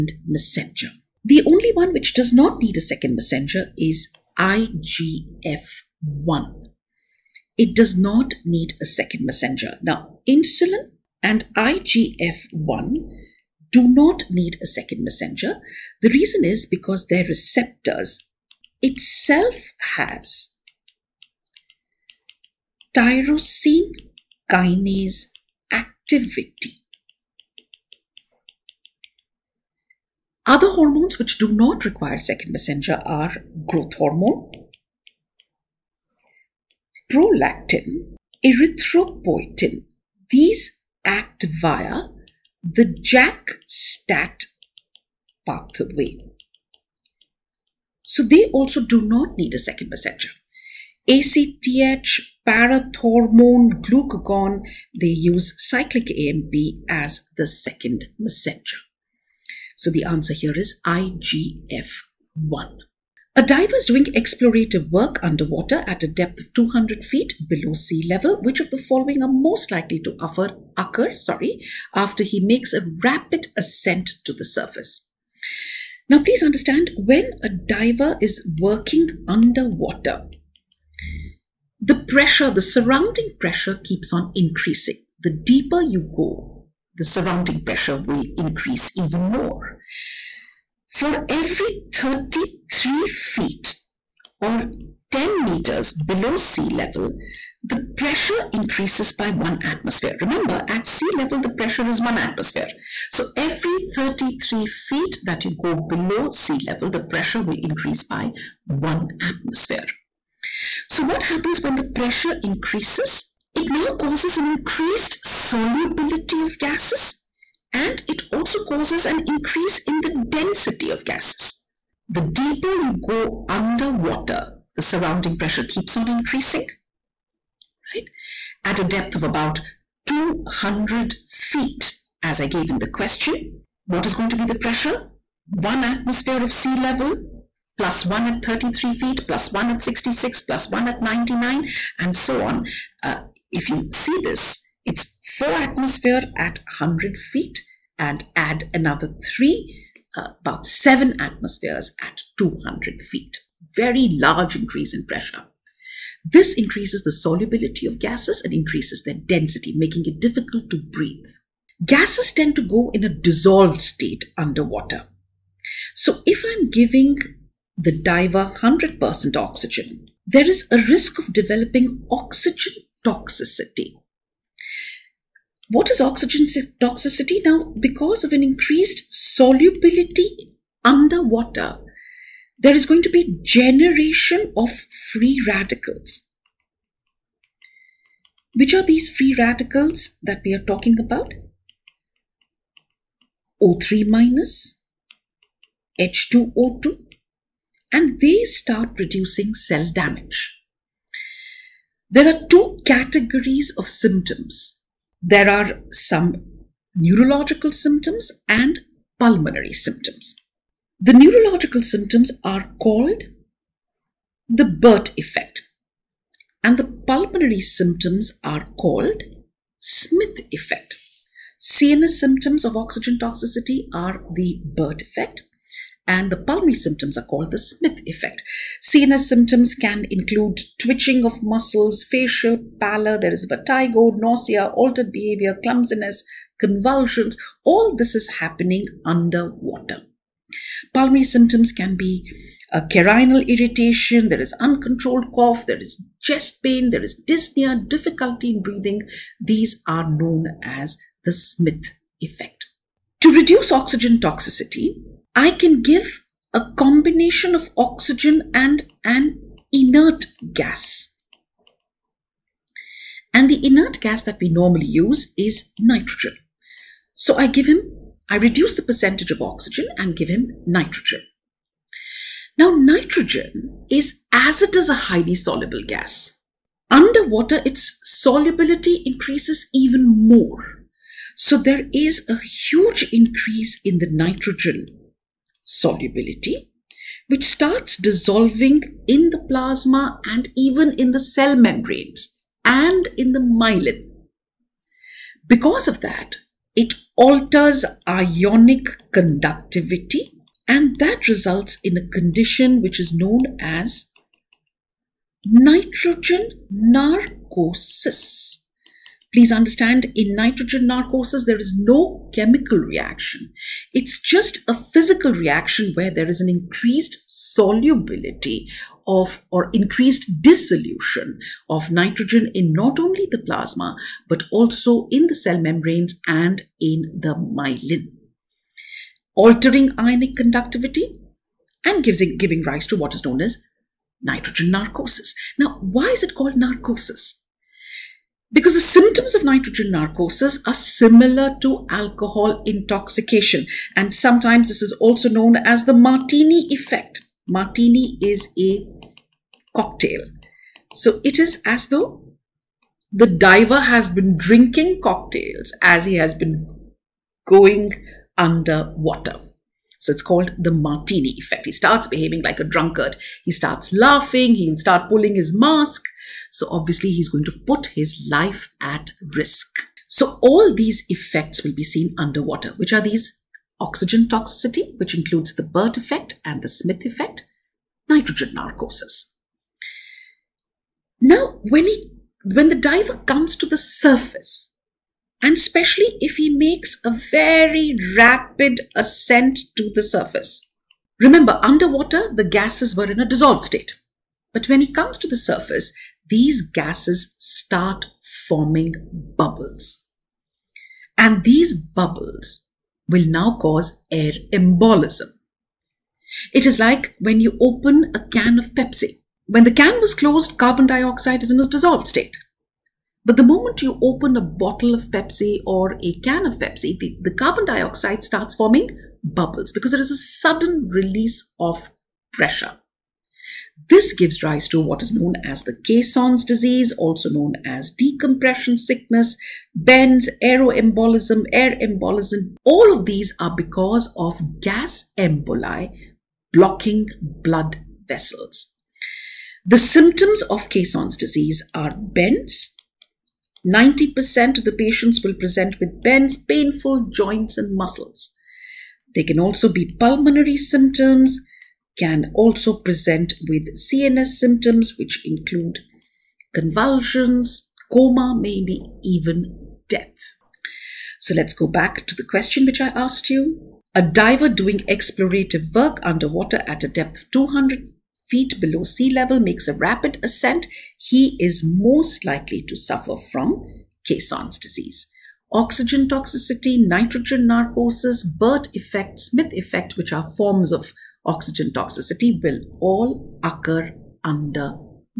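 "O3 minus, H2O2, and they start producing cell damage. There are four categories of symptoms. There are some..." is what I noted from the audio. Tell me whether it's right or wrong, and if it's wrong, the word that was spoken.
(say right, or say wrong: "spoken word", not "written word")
wrong: "two", not "four".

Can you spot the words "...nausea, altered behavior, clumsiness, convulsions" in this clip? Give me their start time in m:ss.
3:54.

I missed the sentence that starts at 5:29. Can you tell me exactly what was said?
Altering ionic conductivity and gives, giving rise to what is known as nitrogen narcosis.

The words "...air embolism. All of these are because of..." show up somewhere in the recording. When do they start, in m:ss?
7:11.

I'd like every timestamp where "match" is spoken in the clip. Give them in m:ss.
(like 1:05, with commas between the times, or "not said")
not said.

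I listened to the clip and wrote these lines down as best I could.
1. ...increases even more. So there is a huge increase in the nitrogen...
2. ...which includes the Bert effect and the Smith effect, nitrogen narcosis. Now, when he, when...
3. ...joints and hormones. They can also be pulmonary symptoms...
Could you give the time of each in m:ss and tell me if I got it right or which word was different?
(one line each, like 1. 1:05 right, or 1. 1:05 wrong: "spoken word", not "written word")
1. 4:39 right
2. 6:14 right
3. 7:27 wrong: "muscles", not "hormones".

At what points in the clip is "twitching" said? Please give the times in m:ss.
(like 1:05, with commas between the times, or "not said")
3:50.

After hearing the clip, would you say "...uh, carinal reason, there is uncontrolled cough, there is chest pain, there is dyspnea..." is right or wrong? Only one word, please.
wrong.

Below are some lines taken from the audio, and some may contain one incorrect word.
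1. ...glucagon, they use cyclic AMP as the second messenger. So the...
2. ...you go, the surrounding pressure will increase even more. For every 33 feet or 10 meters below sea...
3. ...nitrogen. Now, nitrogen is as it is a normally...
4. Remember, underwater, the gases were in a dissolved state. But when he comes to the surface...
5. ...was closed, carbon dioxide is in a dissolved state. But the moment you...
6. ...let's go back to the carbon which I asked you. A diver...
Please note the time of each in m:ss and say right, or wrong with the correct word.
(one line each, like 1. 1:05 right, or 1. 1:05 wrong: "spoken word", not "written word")
1. 0:53 right
2. 1:25 right
3. 4:30 wrong: "highly", not "normally"
4. 6:31 right
5. 6:50 right
6. 7:41 wrong: "question", not "carbon".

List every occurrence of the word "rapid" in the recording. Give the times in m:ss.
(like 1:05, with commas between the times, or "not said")
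1:13, 6:28, 7:49.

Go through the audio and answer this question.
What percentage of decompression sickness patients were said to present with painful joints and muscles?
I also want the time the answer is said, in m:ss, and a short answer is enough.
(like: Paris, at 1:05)
90%, at 7:23.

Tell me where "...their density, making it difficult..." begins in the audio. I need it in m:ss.
2:39.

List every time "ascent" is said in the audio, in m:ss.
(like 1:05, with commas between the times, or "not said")
1:13, 6:28, 7:50.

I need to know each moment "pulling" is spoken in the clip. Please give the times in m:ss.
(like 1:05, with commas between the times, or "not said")
6:05.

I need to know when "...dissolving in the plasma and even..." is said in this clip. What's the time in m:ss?
4:47.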